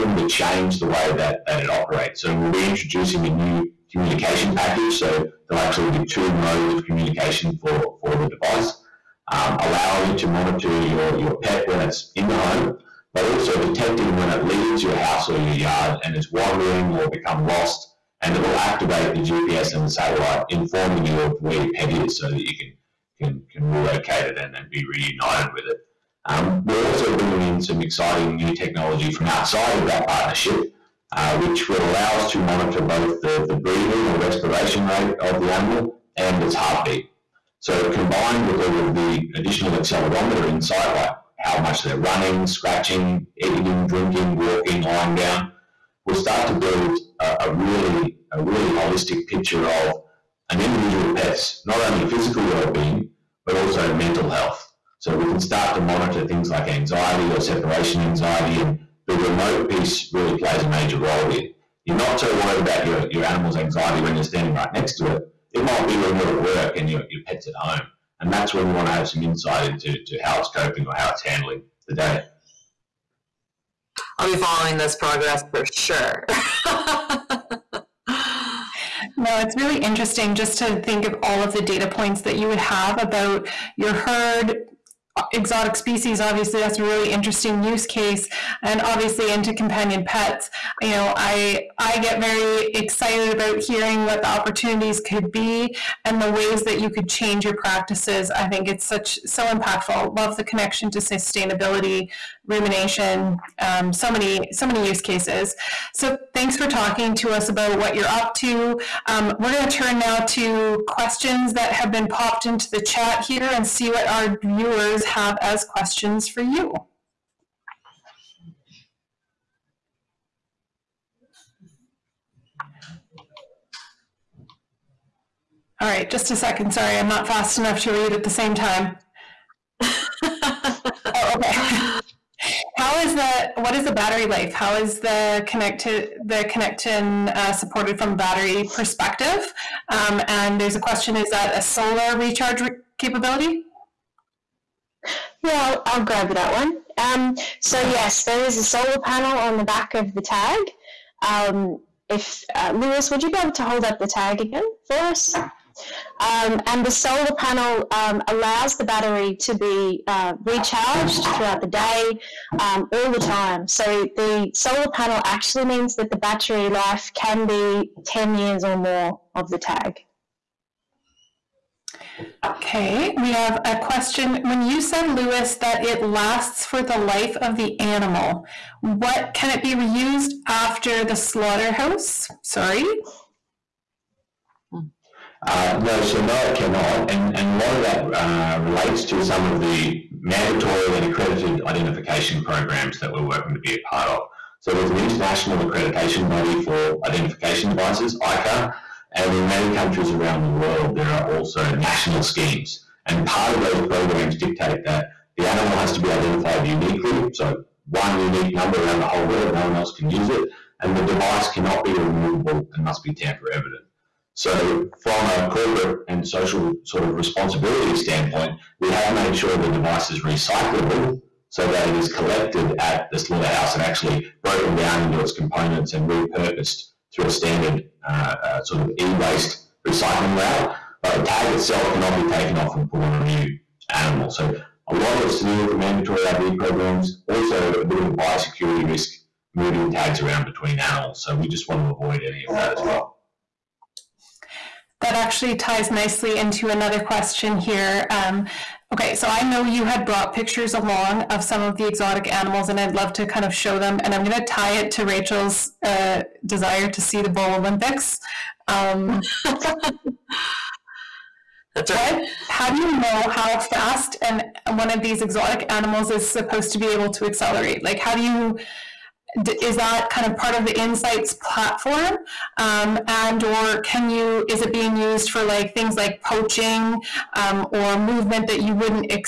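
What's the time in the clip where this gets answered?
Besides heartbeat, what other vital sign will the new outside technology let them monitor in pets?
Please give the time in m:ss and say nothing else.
0:34.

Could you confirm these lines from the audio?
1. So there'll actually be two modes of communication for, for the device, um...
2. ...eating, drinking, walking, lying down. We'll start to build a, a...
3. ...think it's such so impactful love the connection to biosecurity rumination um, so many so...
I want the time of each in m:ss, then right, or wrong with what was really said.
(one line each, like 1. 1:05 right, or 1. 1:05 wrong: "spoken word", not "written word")
1. 0:04 right
2. 0:43 right
3. 1:38 wrong: "sustainability", not "biosecurity".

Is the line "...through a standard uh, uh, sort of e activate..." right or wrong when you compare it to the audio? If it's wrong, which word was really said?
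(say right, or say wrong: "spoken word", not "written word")
wrong: "waste", not "activate".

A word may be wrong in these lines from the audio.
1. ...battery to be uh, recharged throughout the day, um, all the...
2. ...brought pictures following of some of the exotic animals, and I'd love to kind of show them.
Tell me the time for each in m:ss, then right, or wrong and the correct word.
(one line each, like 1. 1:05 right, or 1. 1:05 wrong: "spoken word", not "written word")
1. 2:38 right
2. 4:10 wrong: "along", not "following".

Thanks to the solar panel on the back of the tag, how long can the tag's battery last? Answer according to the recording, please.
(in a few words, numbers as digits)
10 years or more.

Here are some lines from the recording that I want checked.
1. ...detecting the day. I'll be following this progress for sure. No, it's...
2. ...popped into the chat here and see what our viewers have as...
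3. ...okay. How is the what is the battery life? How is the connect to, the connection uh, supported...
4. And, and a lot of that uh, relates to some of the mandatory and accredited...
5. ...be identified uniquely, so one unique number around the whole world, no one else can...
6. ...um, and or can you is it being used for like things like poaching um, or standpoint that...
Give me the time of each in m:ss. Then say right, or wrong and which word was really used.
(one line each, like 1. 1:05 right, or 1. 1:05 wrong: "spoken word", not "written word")
1. 1:11 wrong: "handling", not "detecting"
2. 1:52 right
3. 2:11 right
4. 3:07 right
5. 3:25 right
6. 4:32 wrong: "movement", not "standpoint".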